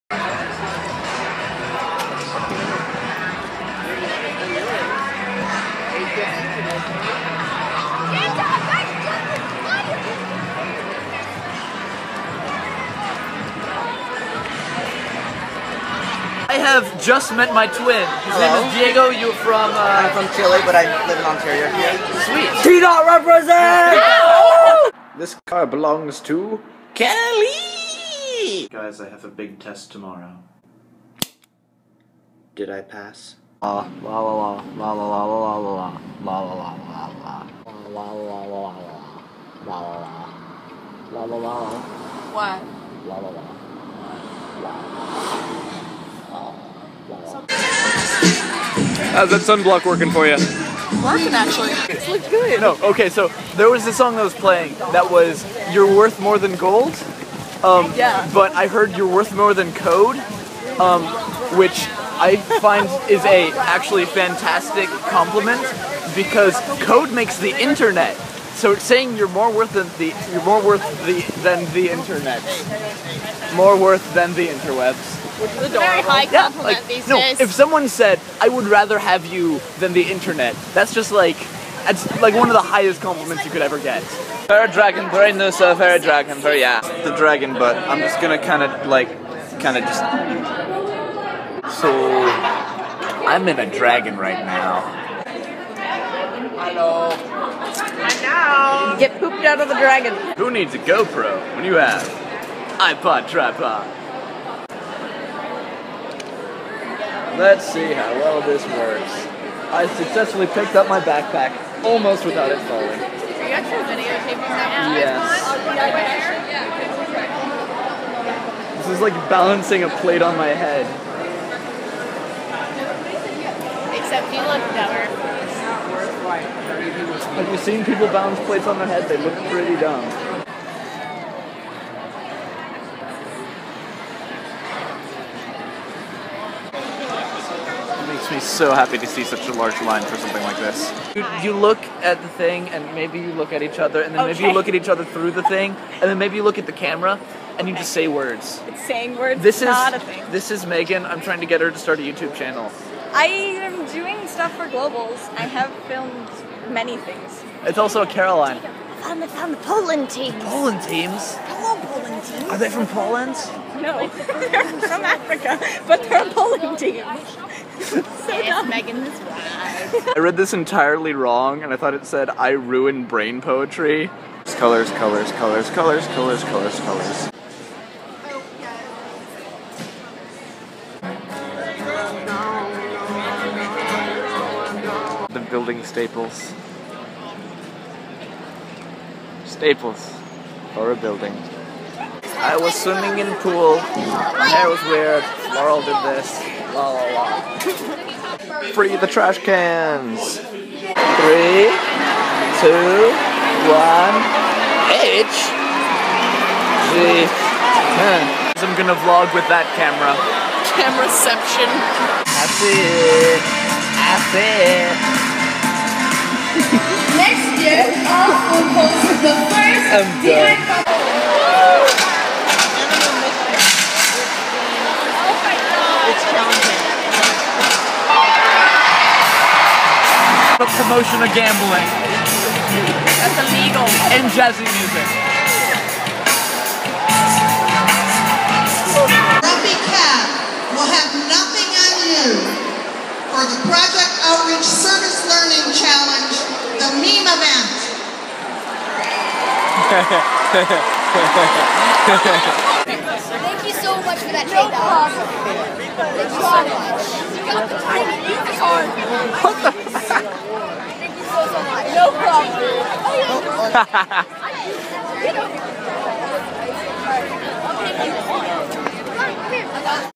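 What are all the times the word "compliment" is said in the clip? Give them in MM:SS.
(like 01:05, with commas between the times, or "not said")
01:05, 01:16, 01:23.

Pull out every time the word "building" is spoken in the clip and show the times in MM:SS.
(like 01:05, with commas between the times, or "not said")
03:05, 03:10.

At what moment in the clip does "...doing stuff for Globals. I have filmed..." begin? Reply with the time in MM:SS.
02:33.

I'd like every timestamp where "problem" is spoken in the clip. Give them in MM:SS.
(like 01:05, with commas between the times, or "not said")
04:22.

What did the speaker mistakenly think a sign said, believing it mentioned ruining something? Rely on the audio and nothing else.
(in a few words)
I ruin brain poetry.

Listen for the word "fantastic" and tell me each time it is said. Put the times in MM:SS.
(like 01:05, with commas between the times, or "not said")
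01:04.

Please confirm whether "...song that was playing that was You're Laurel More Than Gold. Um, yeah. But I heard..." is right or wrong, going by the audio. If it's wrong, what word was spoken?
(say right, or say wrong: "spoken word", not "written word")
wrong: "Worth", not "Laurel".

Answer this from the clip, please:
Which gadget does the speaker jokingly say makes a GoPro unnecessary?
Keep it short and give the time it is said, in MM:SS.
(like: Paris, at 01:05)
iPod tripod, at 01:42.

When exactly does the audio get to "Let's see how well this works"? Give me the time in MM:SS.
01:47.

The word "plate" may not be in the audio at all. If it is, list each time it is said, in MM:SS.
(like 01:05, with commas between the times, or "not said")
01:59, 02:08.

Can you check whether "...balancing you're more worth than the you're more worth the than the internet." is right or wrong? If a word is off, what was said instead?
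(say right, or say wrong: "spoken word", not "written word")
wrong: "saying", not "balancing".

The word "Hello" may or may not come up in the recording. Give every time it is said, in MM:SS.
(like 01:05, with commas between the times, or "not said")
01:36, 02:41.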